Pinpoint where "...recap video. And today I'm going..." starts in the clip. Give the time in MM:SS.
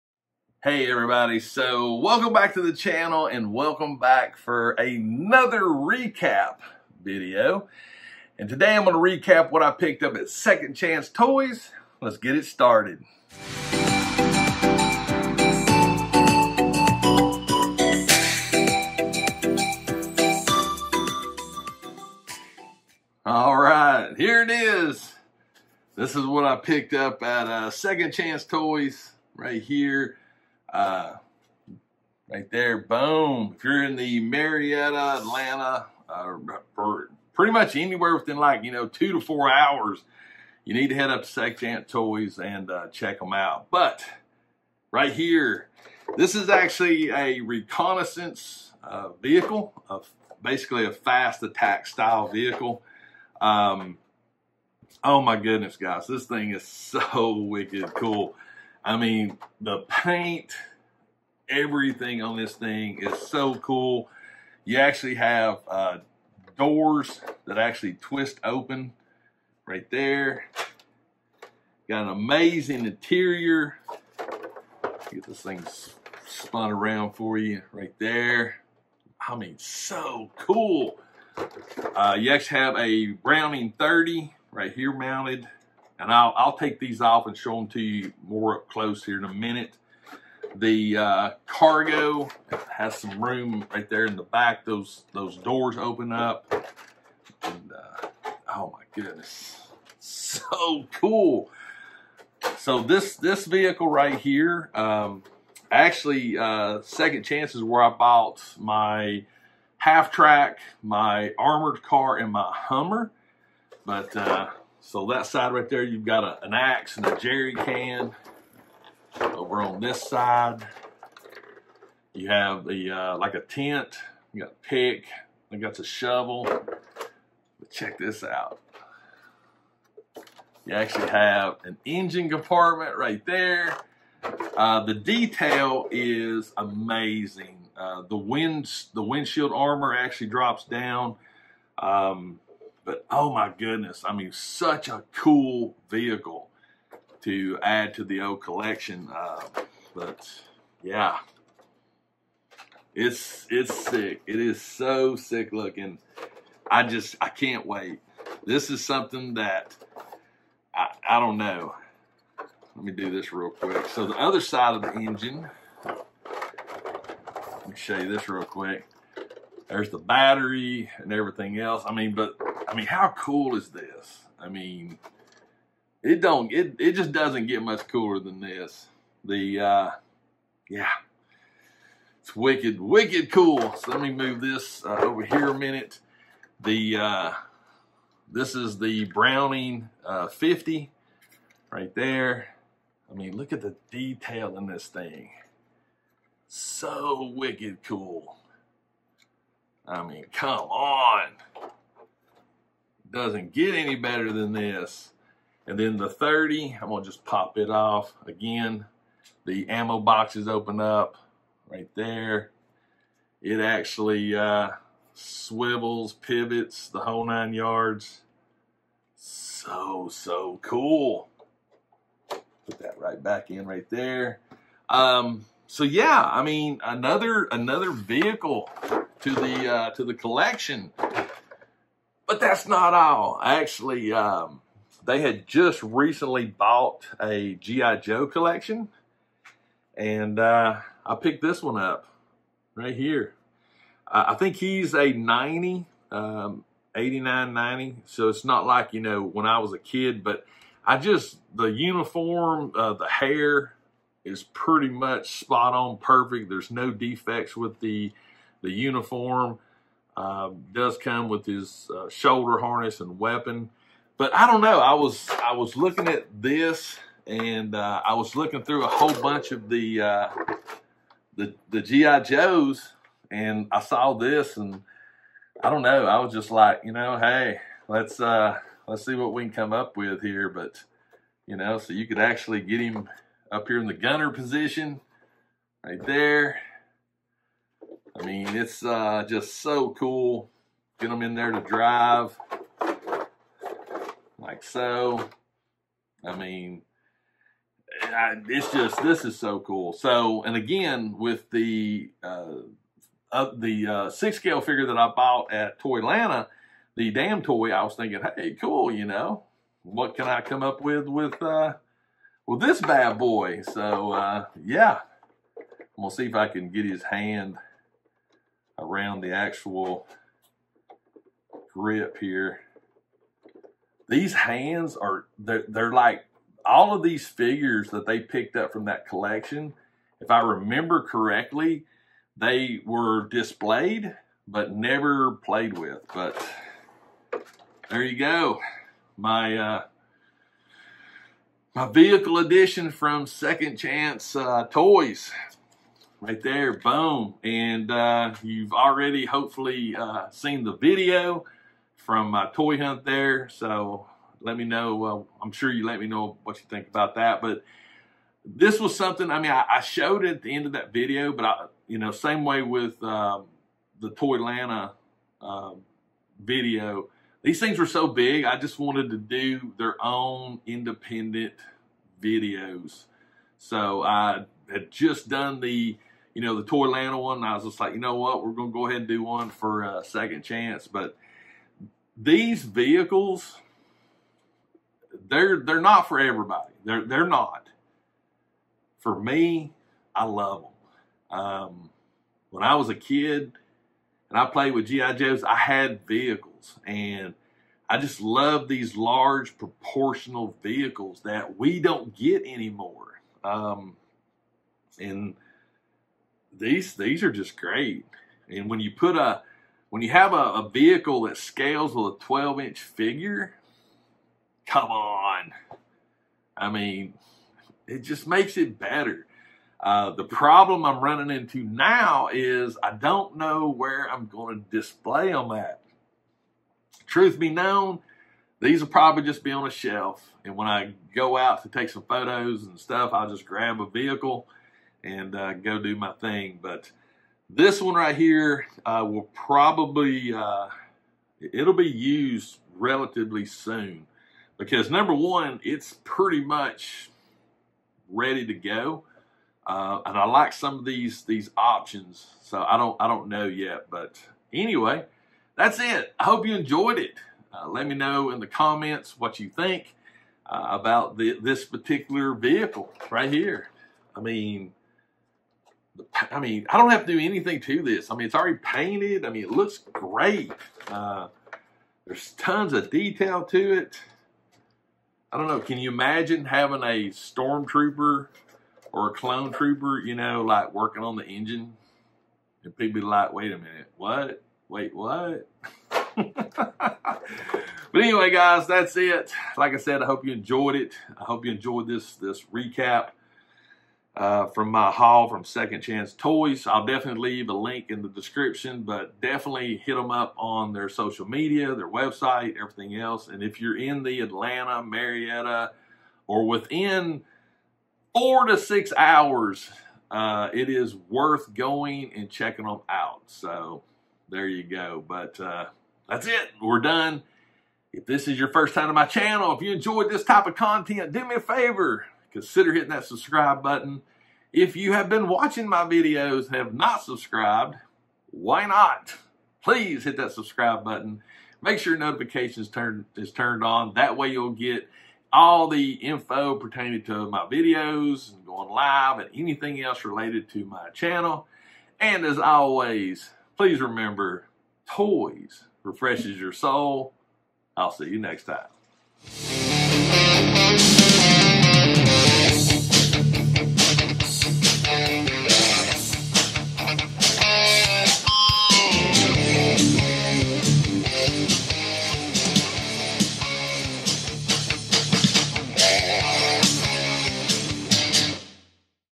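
00:05.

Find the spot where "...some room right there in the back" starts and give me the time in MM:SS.
01:32.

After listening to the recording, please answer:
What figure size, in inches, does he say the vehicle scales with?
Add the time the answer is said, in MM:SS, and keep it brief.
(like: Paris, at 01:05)
12, at 06:52.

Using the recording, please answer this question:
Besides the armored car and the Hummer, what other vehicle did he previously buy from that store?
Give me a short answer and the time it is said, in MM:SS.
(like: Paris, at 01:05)
half track, at 01:49.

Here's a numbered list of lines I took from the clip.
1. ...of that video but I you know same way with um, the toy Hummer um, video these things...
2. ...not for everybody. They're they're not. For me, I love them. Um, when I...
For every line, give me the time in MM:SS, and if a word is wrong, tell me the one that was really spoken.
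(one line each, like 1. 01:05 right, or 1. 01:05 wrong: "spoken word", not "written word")
1. 06:00 wrong: "Atlanta", not "Hummer"
2. 06:25 right.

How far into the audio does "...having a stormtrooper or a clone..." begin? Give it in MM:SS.
07:56.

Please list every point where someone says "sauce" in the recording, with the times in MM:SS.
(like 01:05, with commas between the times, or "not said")
not said.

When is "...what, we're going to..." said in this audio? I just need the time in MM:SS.
06:18.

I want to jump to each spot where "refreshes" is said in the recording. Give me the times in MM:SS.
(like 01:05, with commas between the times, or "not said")
09:05.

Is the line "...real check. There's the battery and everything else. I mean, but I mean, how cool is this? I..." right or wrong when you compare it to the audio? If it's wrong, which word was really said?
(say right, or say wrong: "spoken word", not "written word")
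wrong: "quick", not "check".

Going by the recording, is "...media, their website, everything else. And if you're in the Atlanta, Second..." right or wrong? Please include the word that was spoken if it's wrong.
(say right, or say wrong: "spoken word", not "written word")
wrong: "Marietta", not "Second".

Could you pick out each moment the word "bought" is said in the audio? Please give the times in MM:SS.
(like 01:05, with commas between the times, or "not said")
01:47, 03:56, 05:05.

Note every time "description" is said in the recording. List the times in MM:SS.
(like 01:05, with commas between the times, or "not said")
08:18.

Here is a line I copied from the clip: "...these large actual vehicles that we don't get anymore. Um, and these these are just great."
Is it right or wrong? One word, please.
wrong.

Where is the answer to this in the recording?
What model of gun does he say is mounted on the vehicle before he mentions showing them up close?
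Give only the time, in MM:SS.
01:23.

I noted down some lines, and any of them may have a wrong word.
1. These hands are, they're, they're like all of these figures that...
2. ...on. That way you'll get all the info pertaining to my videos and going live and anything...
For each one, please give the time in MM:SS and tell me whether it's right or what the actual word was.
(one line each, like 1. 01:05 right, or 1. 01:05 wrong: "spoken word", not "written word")
1. 05:24 right
2. 08:53 right.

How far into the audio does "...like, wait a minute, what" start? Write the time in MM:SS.
08:03.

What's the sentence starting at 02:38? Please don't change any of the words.
This is something that I, I don't know.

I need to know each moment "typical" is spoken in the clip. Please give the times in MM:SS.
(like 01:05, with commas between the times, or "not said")
not said.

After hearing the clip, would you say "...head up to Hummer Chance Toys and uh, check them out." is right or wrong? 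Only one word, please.
wrong.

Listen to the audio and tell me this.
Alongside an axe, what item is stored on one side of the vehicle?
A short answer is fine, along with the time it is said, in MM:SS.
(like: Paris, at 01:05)
jerry can, at 01:57.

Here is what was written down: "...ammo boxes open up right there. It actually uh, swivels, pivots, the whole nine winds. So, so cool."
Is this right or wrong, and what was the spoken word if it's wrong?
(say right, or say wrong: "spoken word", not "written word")
wrong: "yards", not "winds".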